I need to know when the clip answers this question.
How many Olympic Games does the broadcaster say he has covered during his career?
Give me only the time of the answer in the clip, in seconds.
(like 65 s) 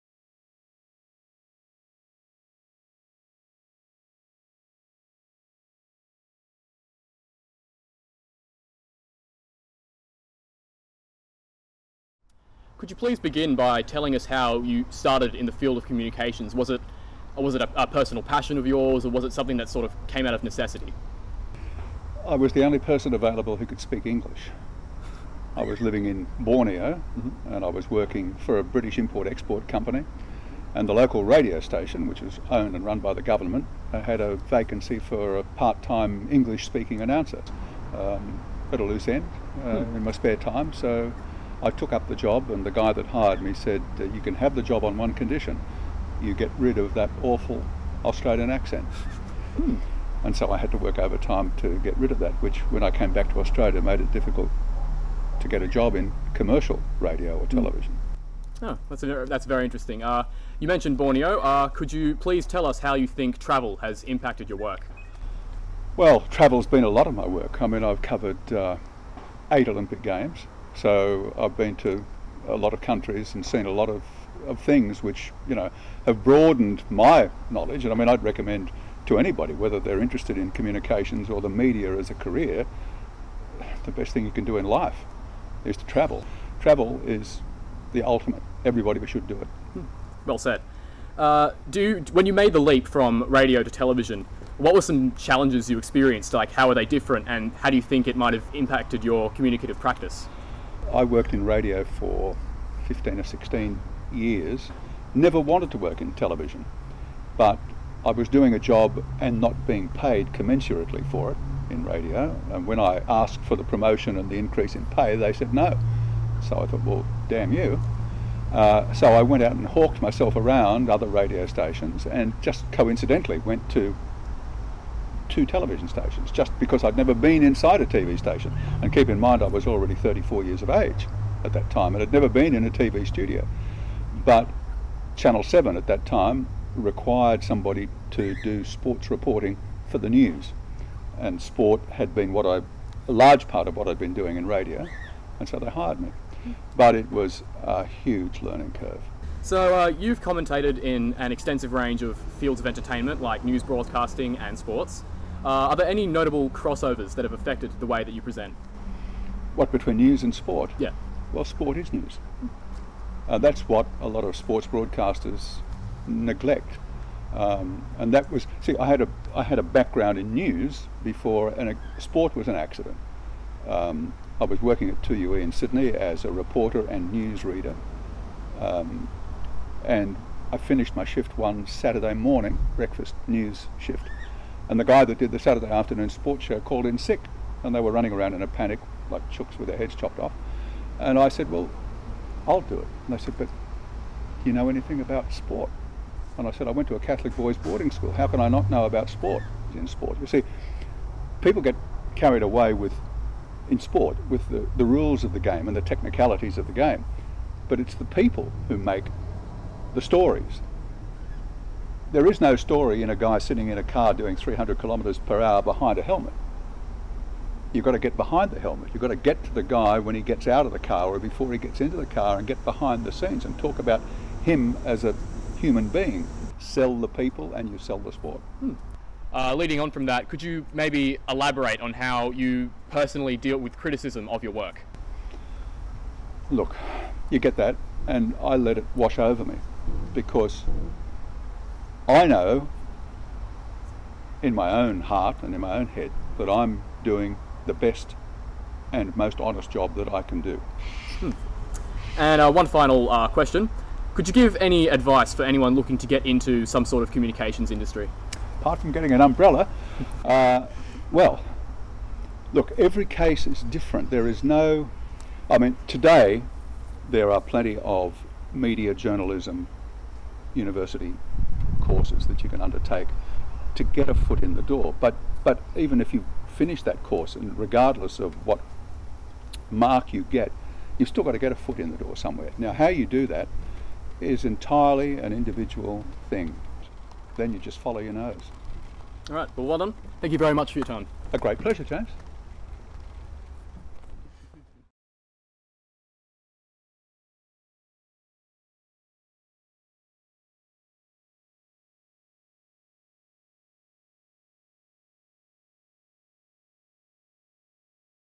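69 s.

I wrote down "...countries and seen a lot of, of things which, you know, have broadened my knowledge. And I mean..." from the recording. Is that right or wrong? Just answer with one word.
right.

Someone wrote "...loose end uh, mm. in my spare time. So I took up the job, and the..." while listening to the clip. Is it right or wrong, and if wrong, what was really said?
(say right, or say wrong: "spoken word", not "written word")
right.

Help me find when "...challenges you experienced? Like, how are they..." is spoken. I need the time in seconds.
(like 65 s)
95 s.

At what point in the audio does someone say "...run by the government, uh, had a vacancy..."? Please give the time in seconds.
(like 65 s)
32 s.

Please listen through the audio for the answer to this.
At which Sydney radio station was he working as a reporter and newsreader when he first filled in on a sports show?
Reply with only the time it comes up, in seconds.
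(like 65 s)
175 s.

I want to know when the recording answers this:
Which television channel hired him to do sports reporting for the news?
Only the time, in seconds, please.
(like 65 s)
135 s.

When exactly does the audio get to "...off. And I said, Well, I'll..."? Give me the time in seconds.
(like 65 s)
190 s.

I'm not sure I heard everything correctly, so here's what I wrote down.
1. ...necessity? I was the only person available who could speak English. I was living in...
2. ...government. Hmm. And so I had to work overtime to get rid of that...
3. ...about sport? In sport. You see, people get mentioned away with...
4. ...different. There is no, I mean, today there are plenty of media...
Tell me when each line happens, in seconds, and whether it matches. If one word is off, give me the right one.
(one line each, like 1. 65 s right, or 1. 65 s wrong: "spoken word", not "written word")
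1. 20 s right
2. 48 s wrong: "accent", not "government"
3. 198 s wrong: "carried", not "mentioned"
4. 263 s right.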